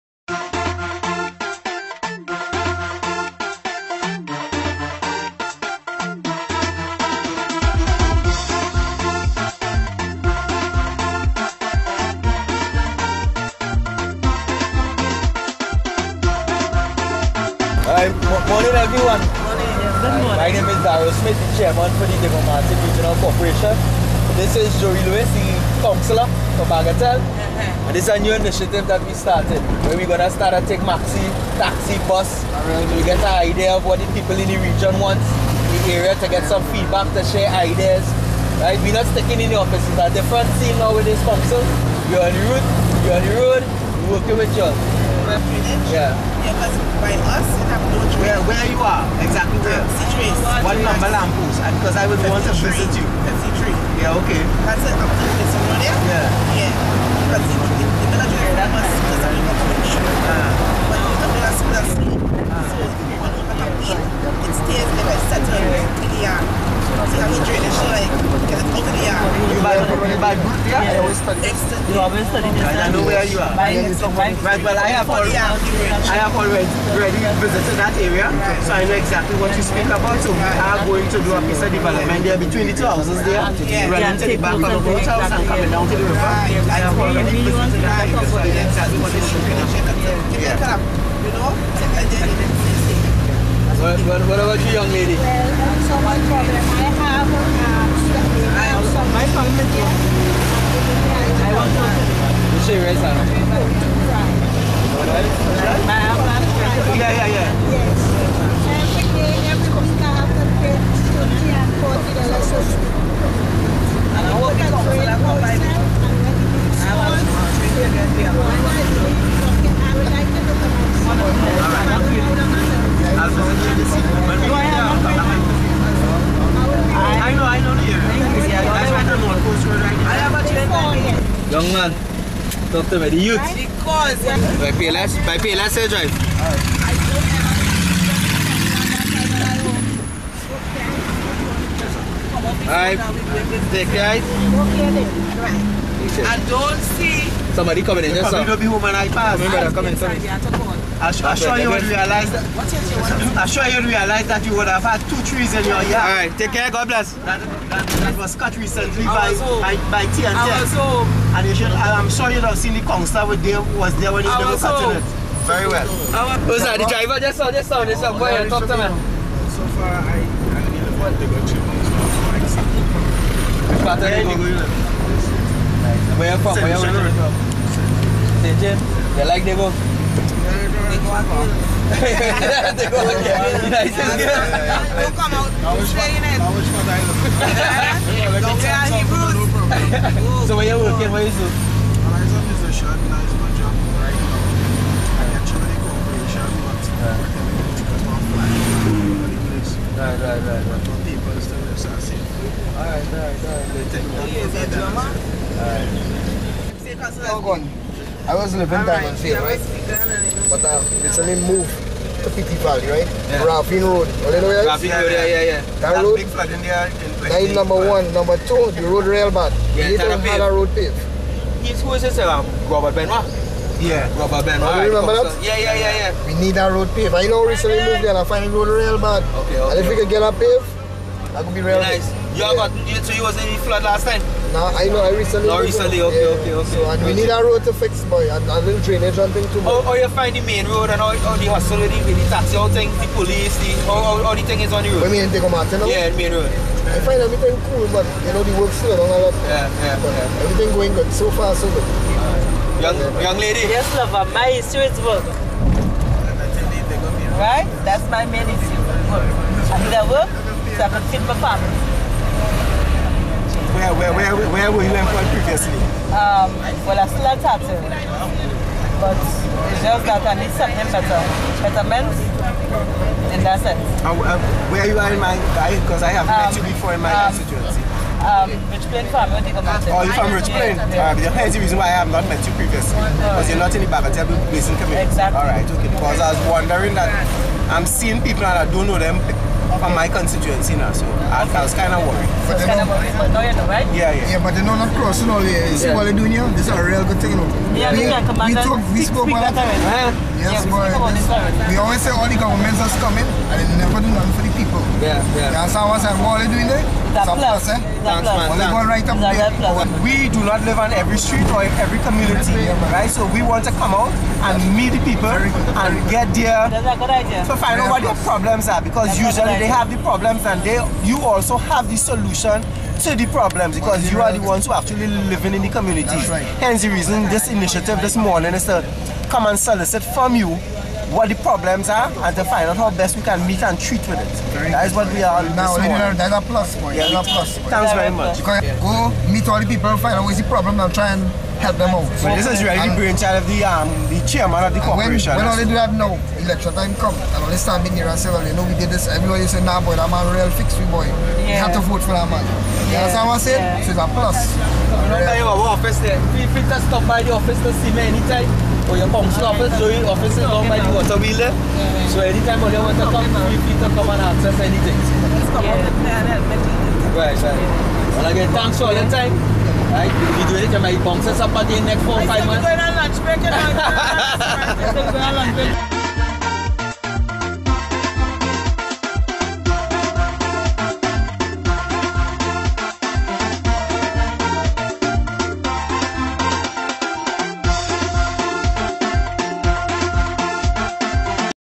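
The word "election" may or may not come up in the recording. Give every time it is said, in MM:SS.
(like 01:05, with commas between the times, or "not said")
05:46.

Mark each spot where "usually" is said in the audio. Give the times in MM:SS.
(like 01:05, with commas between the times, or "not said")
05:19.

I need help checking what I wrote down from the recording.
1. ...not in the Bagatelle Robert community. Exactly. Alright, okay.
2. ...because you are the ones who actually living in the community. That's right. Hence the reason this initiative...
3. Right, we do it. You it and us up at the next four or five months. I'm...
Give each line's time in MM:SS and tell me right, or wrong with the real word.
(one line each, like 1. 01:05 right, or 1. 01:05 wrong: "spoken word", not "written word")
1. 04:43 wrong: "Basin", not "Robert"
2. 05:23 right
3. 06:09 right.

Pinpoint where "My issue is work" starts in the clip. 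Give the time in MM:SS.
04:14.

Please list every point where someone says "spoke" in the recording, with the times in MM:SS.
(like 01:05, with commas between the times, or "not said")
04:59.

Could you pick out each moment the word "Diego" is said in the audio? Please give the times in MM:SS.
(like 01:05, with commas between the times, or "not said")
00:22, 04:05.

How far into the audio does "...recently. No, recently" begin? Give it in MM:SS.
03:55.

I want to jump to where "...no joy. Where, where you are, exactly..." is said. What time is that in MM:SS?
00:47.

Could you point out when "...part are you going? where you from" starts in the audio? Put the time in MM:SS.
02:53.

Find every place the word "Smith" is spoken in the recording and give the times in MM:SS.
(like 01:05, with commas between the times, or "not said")
00:21.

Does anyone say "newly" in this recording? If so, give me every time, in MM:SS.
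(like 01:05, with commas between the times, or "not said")
not said.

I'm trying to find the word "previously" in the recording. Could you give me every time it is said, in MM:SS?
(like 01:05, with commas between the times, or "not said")
04:25, 04:42.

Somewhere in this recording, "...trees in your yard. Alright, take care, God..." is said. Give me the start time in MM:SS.
02:35.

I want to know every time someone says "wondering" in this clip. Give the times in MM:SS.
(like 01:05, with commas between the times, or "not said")
04:46.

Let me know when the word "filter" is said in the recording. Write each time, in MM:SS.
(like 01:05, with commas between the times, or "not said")
05:56, 06:03.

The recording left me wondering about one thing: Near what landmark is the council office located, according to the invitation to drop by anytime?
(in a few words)
the water wheel.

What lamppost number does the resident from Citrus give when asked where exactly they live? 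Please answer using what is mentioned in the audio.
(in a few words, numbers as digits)
53.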